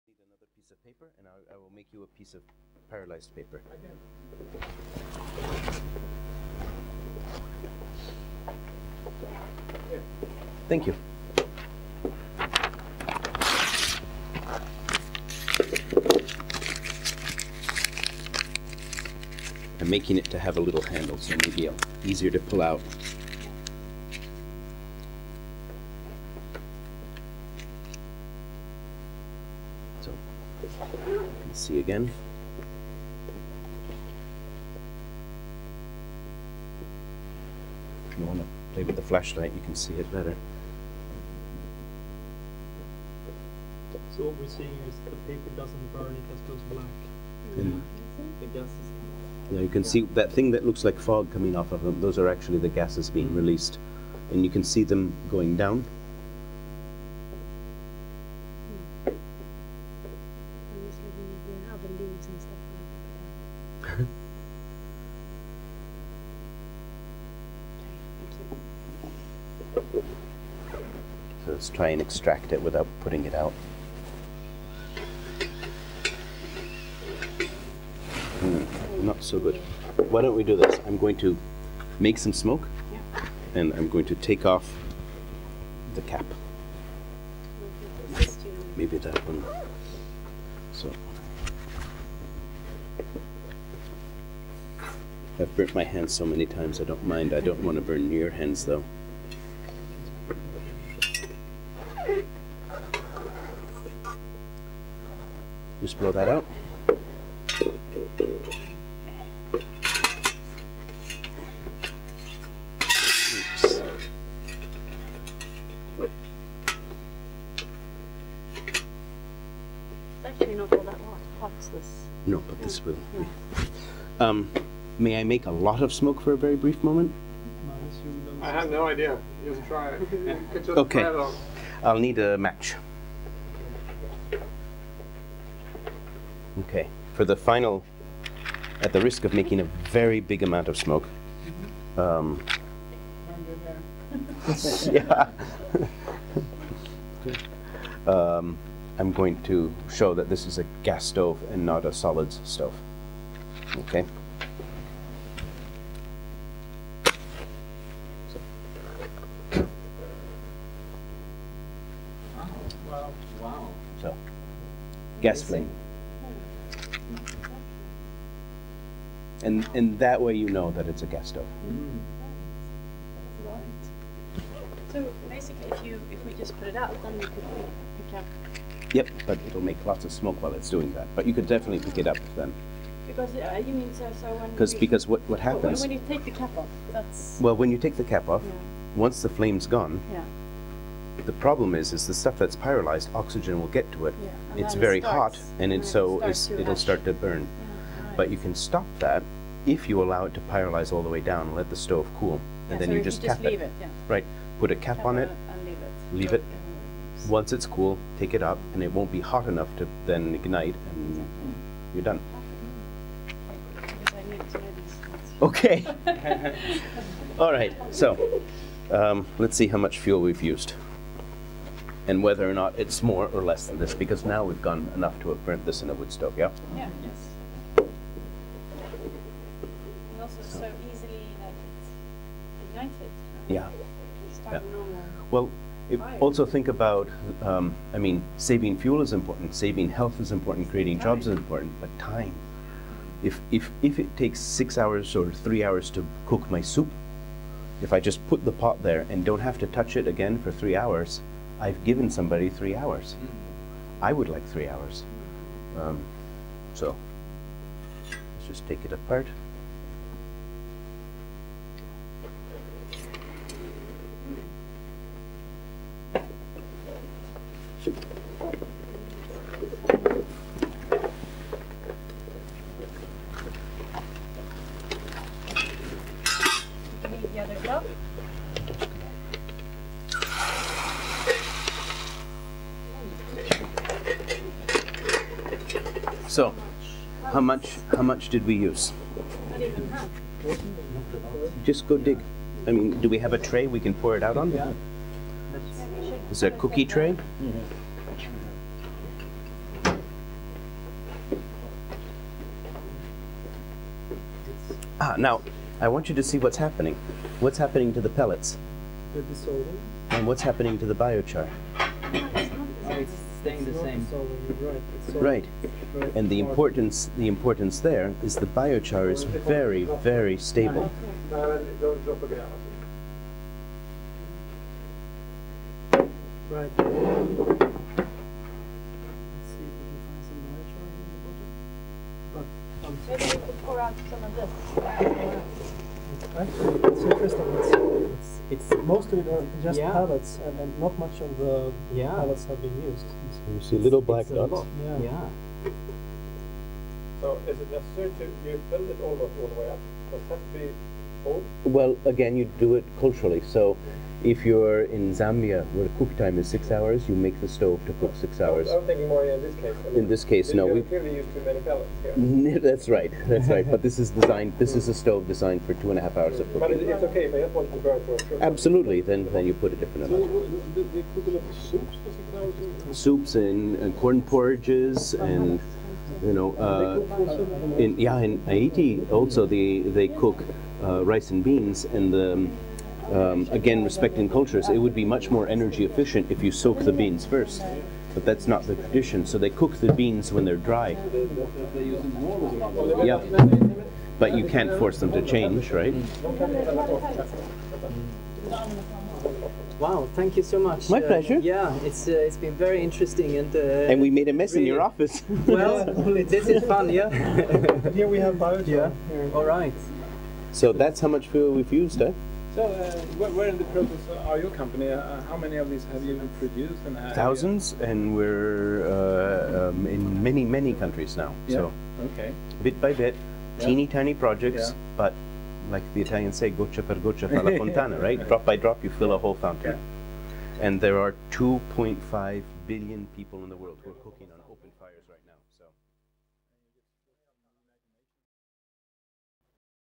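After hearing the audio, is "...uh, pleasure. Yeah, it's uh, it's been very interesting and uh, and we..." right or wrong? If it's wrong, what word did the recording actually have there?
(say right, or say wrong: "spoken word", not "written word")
right.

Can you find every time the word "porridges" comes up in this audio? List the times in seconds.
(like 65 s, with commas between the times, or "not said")
374 s.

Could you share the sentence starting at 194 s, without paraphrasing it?
Yeah, it's very starts, hot, and, so it'll start to burn.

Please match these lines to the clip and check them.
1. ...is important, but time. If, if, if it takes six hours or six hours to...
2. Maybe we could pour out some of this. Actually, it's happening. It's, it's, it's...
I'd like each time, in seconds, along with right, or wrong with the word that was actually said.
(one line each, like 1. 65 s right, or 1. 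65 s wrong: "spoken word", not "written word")
1. 241 s wrong: "three", not "six"
2. 333 s wrong: "interesting", not "happening".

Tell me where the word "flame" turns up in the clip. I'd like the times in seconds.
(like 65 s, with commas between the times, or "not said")
165 s, 189 s.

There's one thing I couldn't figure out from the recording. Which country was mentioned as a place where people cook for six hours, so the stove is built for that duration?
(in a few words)
Zambia.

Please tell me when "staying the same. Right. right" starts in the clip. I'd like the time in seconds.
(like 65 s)
313 s.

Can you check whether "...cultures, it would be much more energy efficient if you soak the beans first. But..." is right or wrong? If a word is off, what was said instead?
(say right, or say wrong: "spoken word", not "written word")
right.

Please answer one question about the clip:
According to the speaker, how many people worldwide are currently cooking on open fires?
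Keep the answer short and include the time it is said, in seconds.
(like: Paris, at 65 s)
2.5 billion, at 431 s.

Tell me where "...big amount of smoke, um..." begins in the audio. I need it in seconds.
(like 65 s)
140 s.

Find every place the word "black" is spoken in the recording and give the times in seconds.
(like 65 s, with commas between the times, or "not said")
46 s, 344 s.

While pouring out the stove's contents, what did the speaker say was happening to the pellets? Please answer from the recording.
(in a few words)
dissolving.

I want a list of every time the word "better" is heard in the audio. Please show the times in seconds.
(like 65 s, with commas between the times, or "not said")
40 s.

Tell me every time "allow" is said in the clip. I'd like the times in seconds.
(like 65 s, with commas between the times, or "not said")
200 s.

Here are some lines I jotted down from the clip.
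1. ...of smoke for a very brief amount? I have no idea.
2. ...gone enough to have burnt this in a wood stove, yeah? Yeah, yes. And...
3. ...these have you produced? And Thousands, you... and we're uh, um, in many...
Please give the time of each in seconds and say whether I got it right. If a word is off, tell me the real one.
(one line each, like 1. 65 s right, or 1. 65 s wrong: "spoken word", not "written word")
1. 125 s wrong: "moment", not "amount"
2. 224 s right
3. 415 s right.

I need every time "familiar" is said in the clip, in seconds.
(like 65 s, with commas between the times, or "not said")
not said.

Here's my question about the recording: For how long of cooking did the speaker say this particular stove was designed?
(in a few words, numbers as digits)
2.5 hours.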